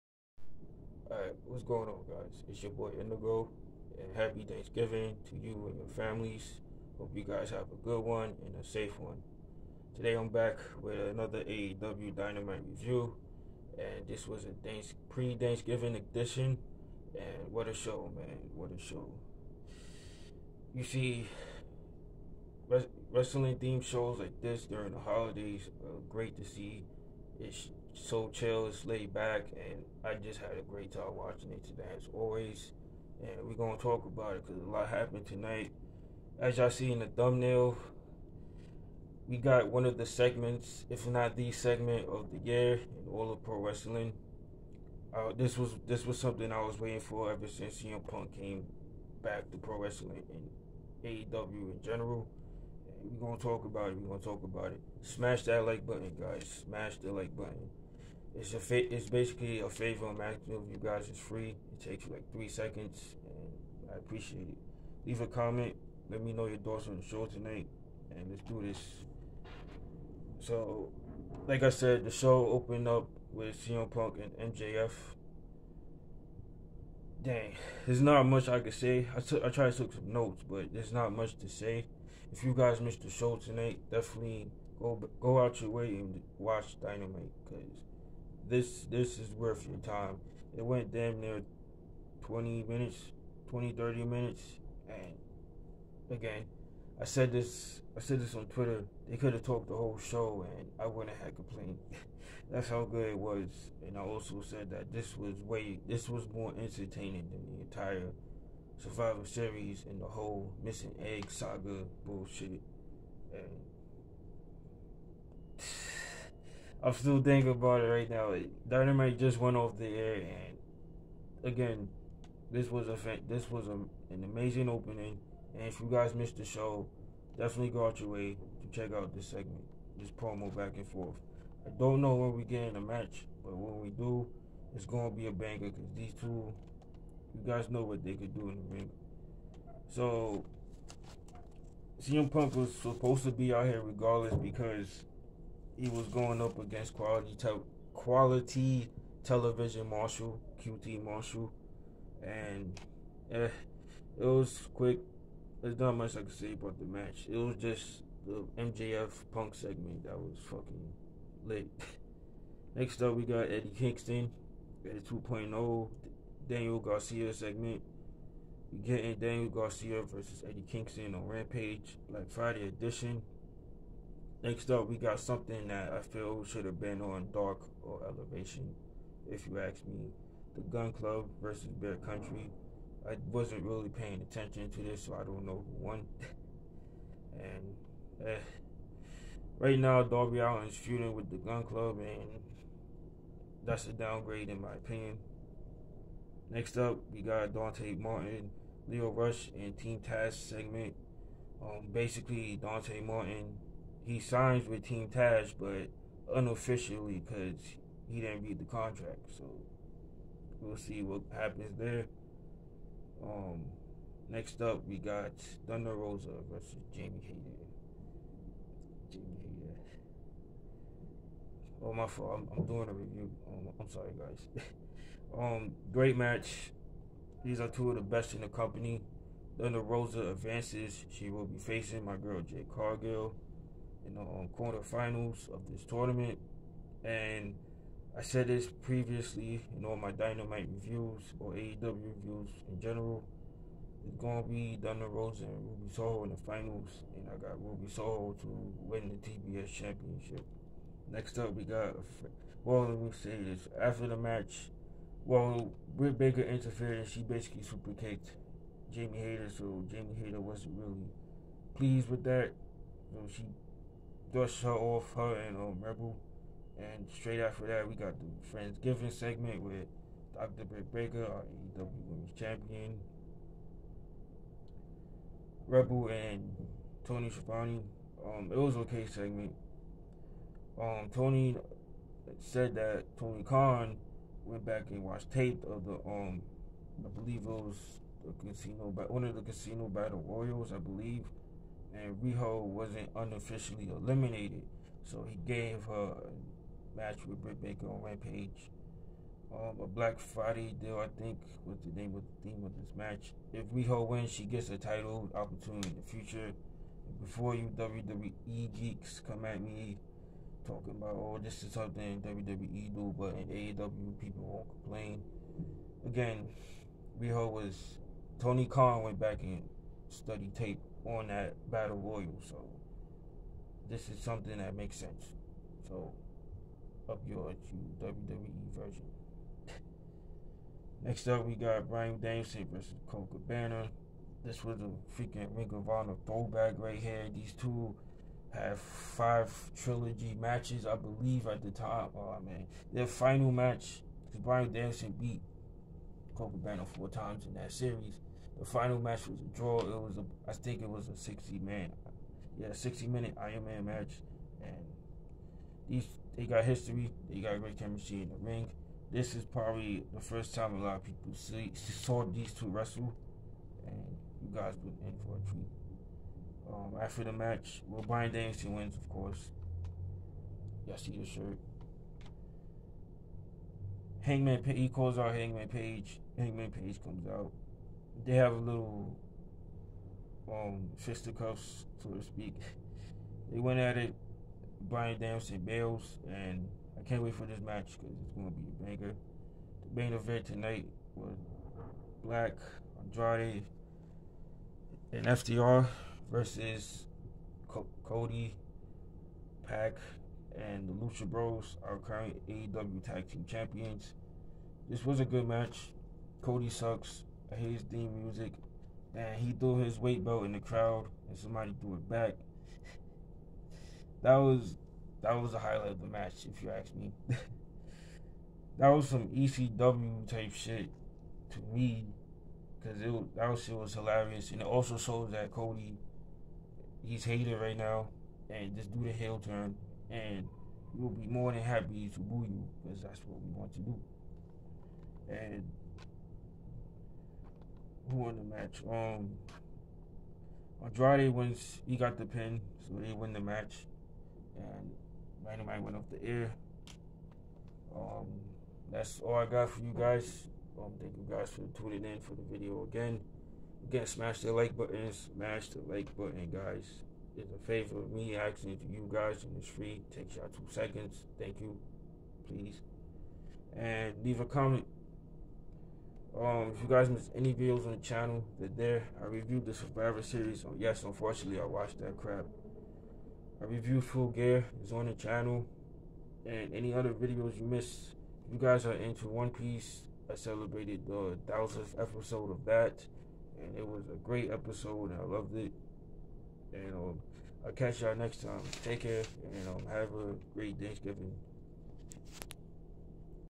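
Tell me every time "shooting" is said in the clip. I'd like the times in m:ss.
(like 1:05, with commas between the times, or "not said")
3:10.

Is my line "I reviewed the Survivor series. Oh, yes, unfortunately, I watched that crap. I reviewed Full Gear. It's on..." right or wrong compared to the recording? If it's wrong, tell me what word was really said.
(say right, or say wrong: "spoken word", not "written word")
right.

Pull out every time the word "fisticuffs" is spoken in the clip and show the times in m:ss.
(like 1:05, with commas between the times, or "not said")
6:20.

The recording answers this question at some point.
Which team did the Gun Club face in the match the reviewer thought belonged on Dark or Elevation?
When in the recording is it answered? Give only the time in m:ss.
3:01.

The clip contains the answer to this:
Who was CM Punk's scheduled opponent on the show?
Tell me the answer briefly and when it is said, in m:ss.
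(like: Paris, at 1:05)
QT Marshall, at 2:30.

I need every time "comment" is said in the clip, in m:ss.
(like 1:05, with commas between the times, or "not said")
1:05, 7:44.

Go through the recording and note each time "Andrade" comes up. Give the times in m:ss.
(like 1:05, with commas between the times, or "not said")
6:32, 7:20.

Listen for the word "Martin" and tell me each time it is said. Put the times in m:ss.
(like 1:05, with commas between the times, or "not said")
3:17, 3:23.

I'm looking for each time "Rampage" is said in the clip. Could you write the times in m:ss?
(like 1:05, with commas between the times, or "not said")
2:51, 4:58.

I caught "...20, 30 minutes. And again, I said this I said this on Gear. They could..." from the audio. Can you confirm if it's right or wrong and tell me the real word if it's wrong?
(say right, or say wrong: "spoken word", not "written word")
wrong: "Twitter", not "Gear".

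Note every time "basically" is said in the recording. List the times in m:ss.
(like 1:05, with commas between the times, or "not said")
0:59, 3:21, 4:17.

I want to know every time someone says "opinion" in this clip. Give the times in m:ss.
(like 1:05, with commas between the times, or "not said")
3:14.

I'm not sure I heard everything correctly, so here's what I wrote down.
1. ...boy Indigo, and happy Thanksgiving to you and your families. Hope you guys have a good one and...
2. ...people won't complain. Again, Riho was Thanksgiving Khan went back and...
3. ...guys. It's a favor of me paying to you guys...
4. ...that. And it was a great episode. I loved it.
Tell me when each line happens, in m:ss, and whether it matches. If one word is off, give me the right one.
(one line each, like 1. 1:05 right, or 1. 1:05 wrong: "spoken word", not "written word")
1. 0:02 right
2. 5:14 wrong: "Tony", not "Thanksgiving"
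3. 7:36 wrong: "asking", not "paying"
4. 8:02 right.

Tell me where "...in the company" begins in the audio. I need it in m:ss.
3:48.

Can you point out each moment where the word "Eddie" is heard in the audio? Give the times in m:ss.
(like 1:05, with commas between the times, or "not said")
2:43, 2:50.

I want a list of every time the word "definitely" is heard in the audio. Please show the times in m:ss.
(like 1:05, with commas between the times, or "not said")
1:23, 2:07.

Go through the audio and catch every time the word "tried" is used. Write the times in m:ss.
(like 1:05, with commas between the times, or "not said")
1:19.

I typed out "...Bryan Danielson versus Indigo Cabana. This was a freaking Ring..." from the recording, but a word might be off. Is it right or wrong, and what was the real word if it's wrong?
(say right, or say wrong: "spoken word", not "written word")
wrong: "Colt", not "Indigo".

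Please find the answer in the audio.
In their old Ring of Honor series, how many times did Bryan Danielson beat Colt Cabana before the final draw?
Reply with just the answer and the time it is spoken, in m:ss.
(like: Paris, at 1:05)
4, at 5:46.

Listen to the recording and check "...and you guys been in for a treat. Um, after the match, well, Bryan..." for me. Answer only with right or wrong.
right.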